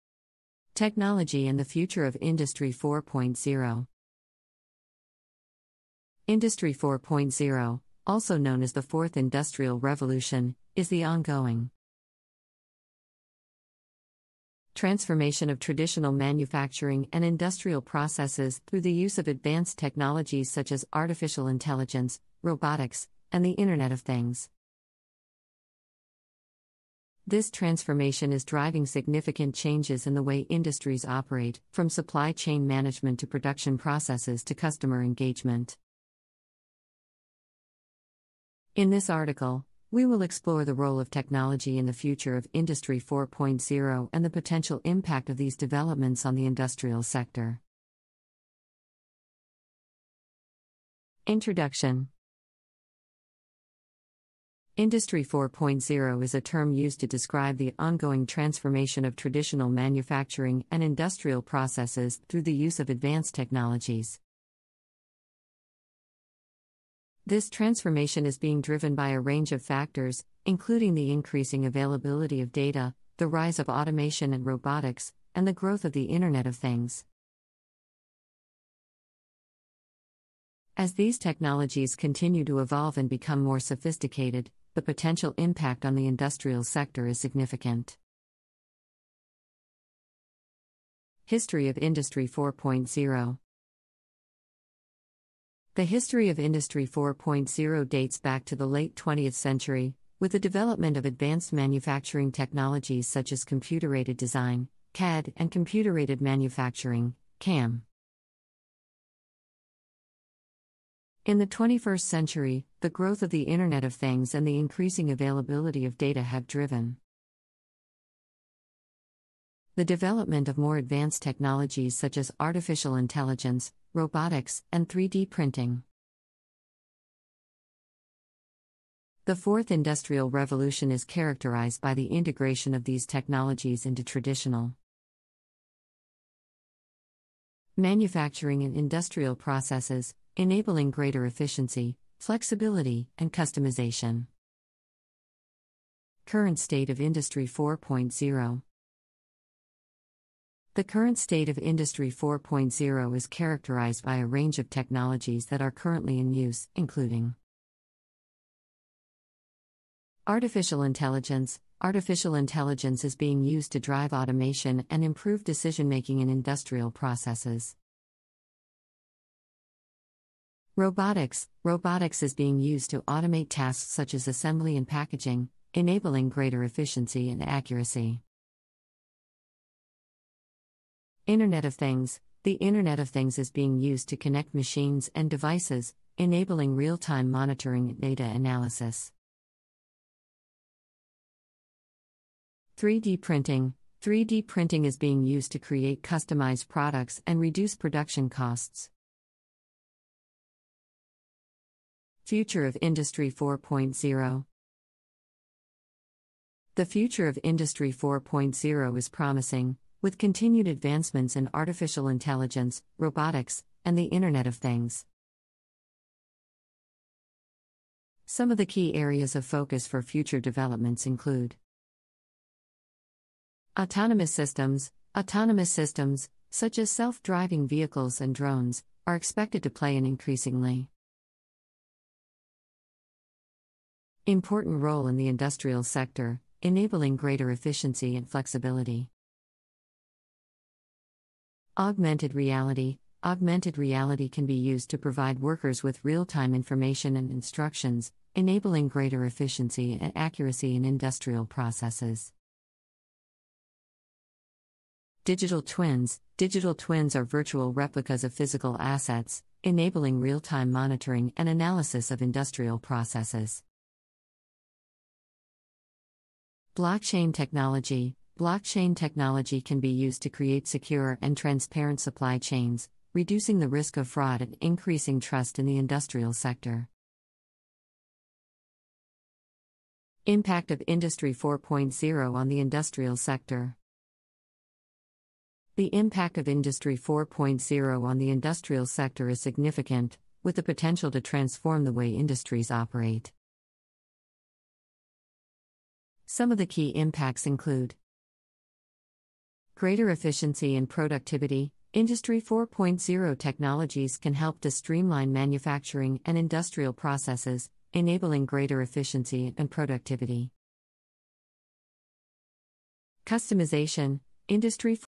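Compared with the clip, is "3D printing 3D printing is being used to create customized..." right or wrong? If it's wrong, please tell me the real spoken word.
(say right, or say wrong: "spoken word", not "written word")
right.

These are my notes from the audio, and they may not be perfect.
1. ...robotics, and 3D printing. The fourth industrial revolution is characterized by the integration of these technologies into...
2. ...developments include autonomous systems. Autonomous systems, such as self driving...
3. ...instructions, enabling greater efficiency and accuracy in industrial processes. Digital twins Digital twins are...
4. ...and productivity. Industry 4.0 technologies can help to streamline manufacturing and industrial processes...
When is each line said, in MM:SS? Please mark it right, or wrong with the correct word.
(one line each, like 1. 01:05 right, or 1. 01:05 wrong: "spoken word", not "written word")
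1. 02:03 right
2. 03:40 right
3. 04:07 right
4. 05:00 right.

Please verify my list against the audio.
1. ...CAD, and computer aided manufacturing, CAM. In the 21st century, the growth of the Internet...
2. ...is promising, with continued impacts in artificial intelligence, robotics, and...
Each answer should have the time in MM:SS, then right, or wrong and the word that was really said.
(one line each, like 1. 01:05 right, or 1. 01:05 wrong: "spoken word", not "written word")
1. 01:44 right
2. 03:28 wrong: "advancements", not "impacts".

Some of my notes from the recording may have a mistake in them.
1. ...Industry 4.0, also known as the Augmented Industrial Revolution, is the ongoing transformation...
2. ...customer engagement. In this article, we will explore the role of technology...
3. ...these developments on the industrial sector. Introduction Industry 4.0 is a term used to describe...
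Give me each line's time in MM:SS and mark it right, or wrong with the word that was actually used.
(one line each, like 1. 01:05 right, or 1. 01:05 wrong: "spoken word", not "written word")
1. 00:06 wrong: "Fourth", not "Augmented"
2. 00:34 right
3. 00:45 right.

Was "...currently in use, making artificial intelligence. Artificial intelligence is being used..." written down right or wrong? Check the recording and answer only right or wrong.
wrong.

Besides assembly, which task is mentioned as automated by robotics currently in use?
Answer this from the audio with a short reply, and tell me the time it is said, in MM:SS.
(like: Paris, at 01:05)
packaging, at 02:54.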